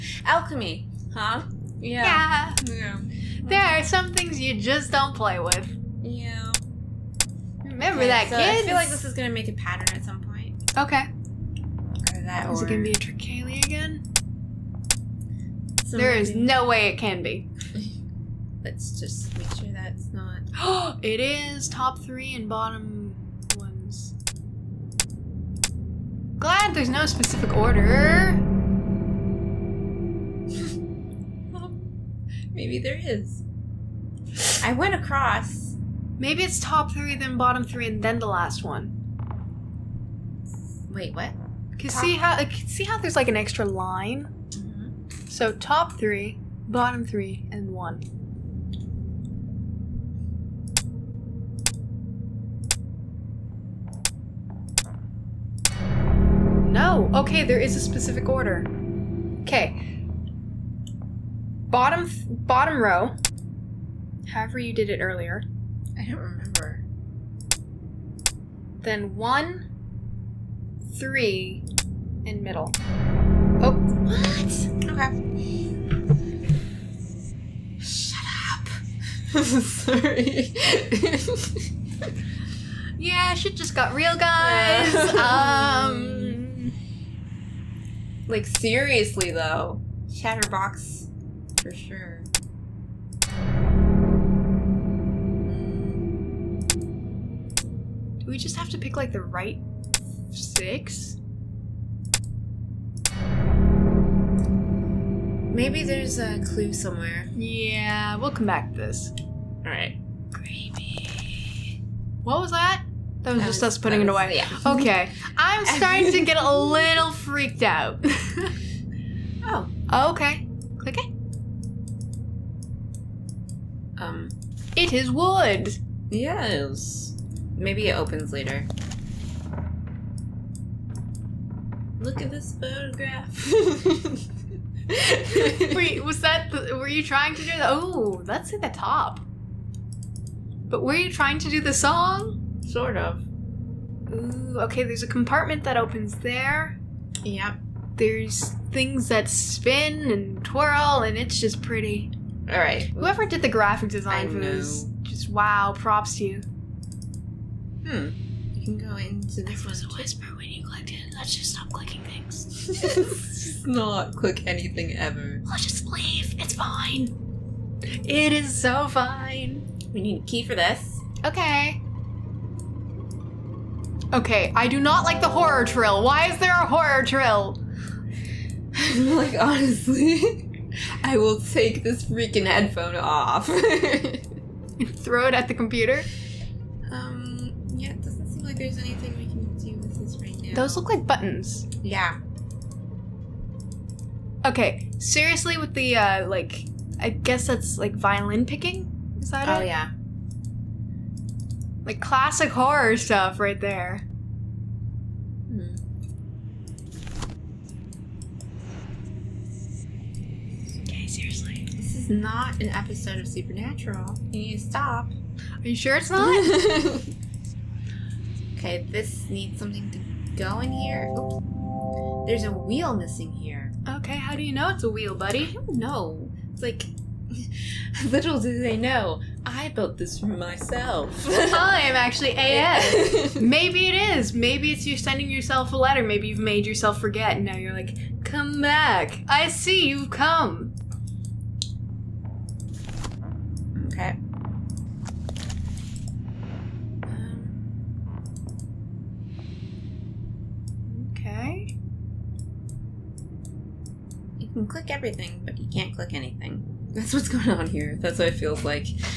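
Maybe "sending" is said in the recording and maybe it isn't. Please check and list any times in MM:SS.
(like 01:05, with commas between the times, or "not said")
03:54.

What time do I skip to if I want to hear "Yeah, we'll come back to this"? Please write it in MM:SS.
01:47.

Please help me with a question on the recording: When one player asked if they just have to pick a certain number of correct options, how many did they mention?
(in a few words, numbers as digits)
6.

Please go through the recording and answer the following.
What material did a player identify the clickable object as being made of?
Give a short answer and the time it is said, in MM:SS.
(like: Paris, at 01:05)
wood, at 02:05.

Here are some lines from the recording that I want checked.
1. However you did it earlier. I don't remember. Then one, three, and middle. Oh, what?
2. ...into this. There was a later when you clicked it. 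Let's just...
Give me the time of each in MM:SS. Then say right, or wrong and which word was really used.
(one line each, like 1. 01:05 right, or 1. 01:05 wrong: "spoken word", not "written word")
1. 01:04 right
2. 02:38 wrong: "whisper", not "later".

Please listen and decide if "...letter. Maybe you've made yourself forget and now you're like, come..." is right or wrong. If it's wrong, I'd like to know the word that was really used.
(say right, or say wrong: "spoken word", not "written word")
right.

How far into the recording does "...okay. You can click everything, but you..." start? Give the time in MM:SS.
04:11.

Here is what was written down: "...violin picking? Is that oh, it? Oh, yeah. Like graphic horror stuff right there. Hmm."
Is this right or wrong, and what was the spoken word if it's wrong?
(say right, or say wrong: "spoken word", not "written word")
wrong: "classic", not "graphic".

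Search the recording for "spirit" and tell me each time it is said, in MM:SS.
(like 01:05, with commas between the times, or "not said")
not said.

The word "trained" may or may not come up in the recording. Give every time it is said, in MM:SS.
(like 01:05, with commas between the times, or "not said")
not said.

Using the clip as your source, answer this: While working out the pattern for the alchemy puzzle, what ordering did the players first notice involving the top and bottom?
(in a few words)
top three and bottom ones.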